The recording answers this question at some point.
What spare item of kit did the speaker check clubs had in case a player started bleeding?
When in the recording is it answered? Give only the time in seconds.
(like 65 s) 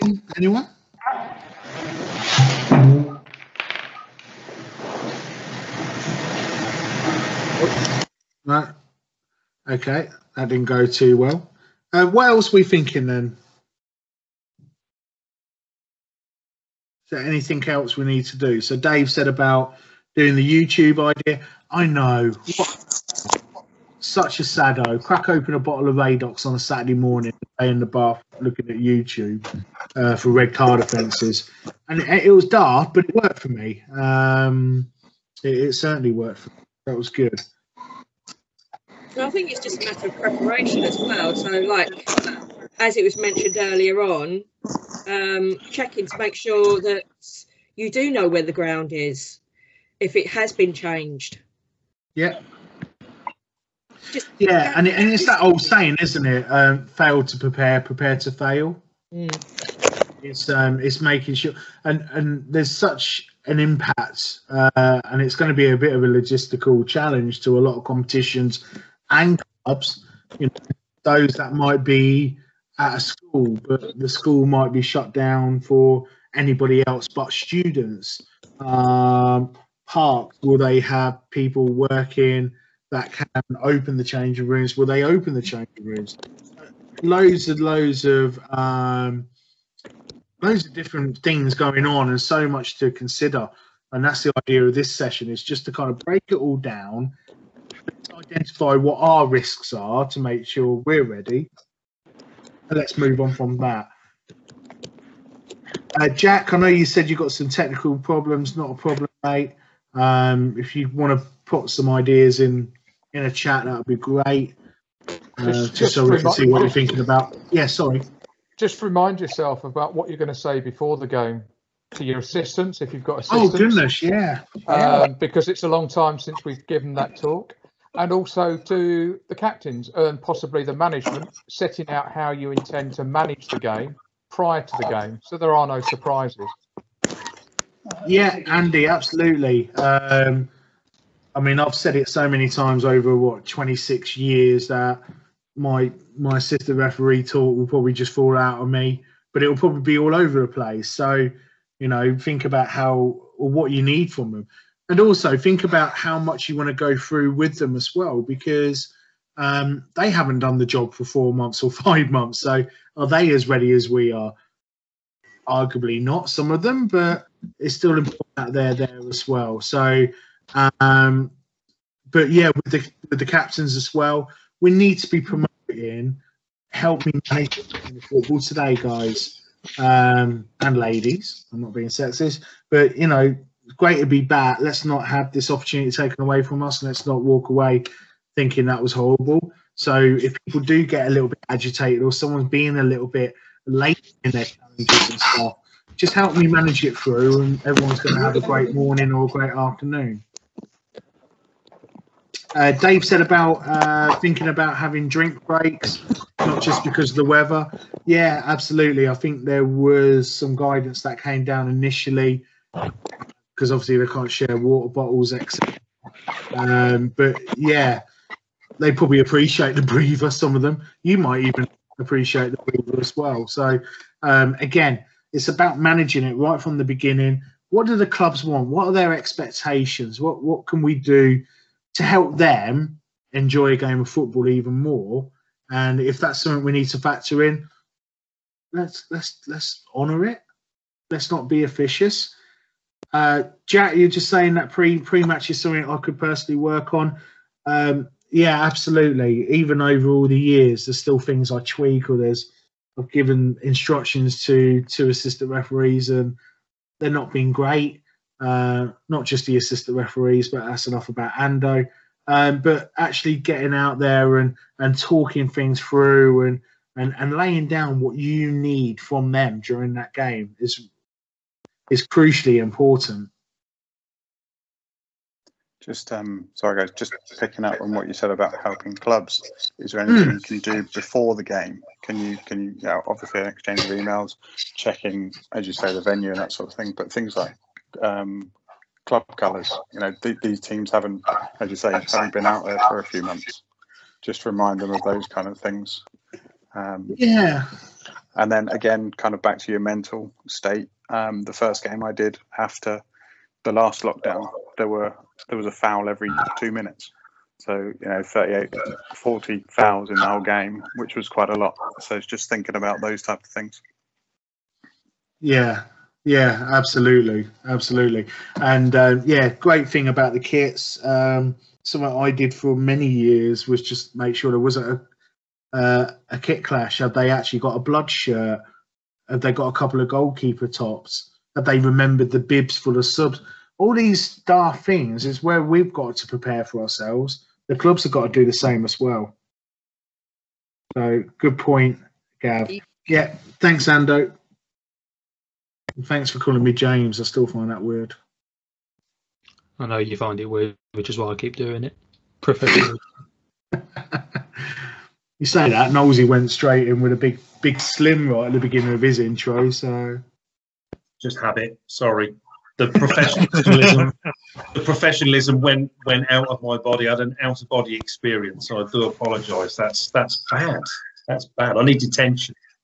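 327 s.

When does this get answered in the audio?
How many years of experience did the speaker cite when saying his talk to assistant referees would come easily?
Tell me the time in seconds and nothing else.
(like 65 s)
143 s.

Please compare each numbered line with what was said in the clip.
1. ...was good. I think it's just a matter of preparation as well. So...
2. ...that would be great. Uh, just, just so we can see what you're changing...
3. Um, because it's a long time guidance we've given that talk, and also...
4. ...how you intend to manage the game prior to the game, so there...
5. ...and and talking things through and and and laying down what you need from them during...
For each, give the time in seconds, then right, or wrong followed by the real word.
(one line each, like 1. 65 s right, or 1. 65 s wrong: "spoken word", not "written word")
1. 36 s right
2. 113 s wrong: "thinking", not "changing"
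3. 124 s wrong: "since", not "guidance"
4. 132 s right
5. 264 s right.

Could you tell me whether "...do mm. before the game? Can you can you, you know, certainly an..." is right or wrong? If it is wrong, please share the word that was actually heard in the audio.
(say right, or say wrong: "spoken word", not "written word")
wrong: "obviously", not "certainly".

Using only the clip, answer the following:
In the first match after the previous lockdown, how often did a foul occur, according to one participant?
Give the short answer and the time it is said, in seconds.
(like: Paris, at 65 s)
every 2 minutes, at 306 s.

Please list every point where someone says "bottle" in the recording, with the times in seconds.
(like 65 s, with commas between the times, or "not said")
25 s, 214 s.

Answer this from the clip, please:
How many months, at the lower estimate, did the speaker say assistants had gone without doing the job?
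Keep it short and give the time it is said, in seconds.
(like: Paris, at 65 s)
4, at 161 s.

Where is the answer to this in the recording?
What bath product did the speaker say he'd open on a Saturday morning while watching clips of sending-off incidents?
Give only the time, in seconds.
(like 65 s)
25 s.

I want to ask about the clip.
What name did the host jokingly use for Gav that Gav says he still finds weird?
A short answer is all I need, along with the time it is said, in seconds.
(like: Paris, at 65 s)
James, at 346 s.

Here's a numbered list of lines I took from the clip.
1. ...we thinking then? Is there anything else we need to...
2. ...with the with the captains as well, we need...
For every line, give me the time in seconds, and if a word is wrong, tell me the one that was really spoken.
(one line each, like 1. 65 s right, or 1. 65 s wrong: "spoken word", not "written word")
1. 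12 s right
2. 172 s right.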